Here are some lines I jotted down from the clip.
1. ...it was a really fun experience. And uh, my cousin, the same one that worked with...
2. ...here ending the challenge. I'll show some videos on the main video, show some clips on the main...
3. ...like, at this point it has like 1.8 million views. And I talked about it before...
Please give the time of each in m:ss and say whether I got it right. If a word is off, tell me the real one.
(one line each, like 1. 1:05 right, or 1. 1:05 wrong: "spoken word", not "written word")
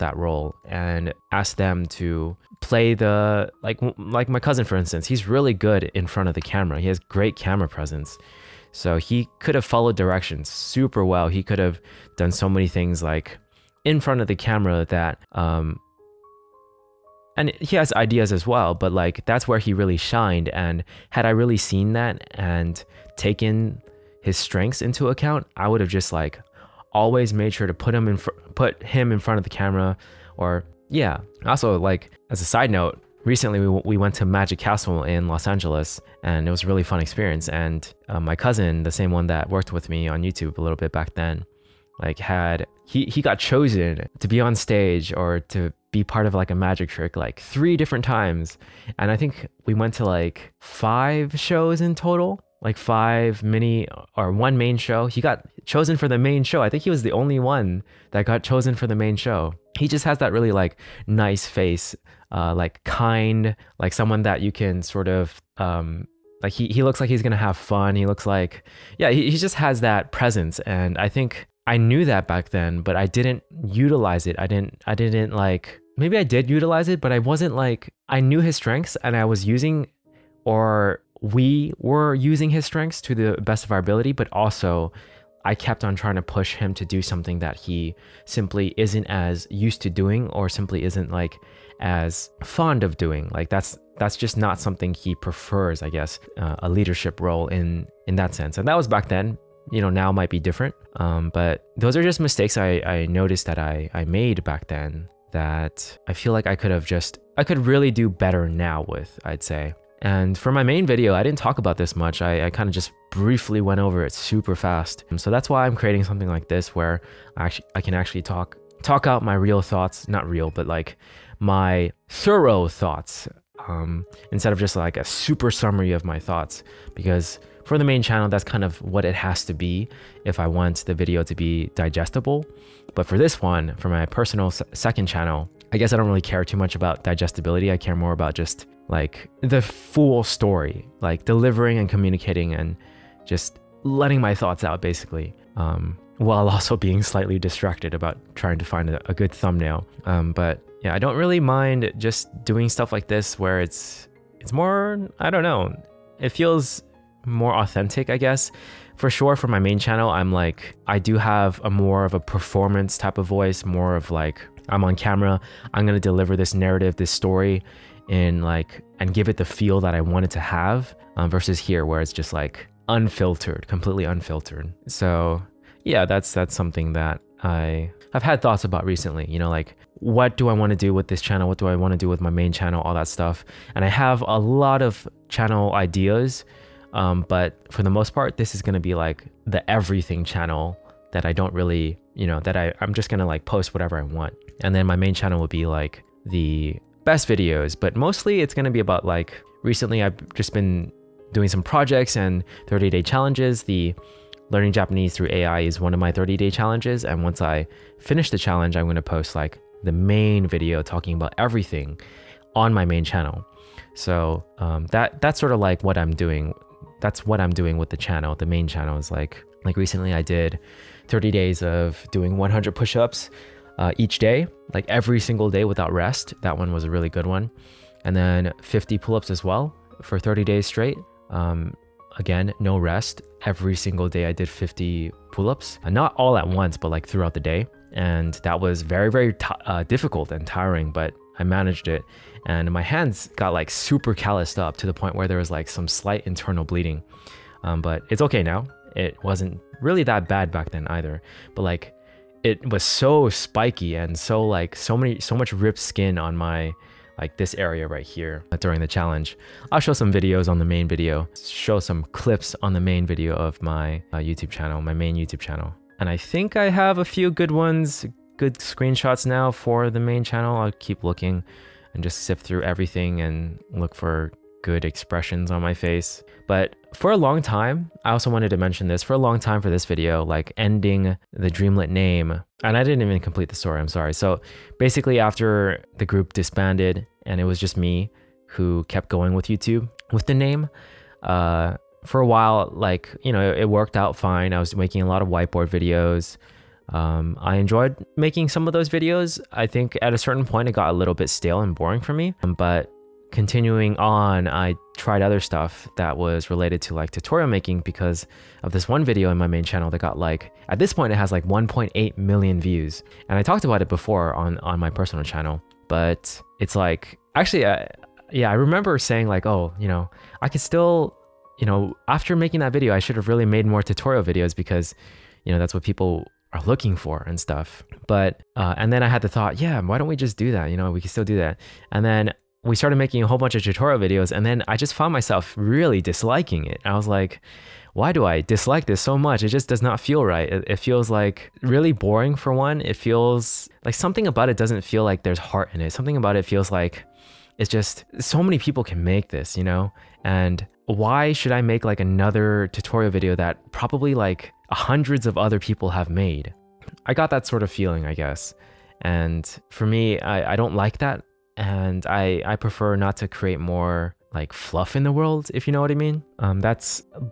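1. 0:36 right
2. 4:18 wrong: "during", not "ending"
3. 5:10 right.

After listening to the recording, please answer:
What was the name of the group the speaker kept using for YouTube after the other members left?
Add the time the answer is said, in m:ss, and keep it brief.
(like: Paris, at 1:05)
Dreamlet, at 4:41.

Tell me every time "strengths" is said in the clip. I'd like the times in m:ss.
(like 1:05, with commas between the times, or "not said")
0:24, 1:18, 1:22.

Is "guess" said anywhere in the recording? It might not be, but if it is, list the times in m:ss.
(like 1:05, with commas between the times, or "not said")
1:35, 2:15, 2:38, 5:58.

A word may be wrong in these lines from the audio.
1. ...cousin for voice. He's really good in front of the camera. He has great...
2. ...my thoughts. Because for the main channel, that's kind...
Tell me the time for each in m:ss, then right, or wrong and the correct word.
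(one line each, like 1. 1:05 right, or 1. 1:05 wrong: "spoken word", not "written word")
1. 0:04 wrong: "instance", not "voice"
2. 2:06 right.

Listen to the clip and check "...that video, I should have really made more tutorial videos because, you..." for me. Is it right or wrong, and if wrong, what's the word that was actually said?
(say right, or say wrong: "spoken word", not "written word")
right.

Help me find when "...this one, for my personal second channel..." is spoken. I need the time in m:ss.
2:13.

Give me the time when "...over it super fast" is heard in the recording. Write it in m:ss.
1:53.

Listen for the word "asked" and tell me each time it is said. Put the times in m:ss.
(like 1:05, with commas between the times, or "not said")
0:01.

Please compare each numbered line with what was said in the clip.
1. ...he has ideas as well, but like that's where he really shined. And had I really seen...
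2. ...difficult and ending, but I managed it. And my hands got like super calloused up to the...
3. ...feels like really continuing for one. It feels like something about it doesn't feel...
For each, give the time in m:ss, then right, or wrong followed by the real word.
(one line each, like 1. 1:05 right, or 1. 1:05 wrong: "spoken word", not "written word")
1. 0:17 right
2. 3:59 wrong: "tiring", not "ending"
3. 5:40 wrong: "boring", not "continuing".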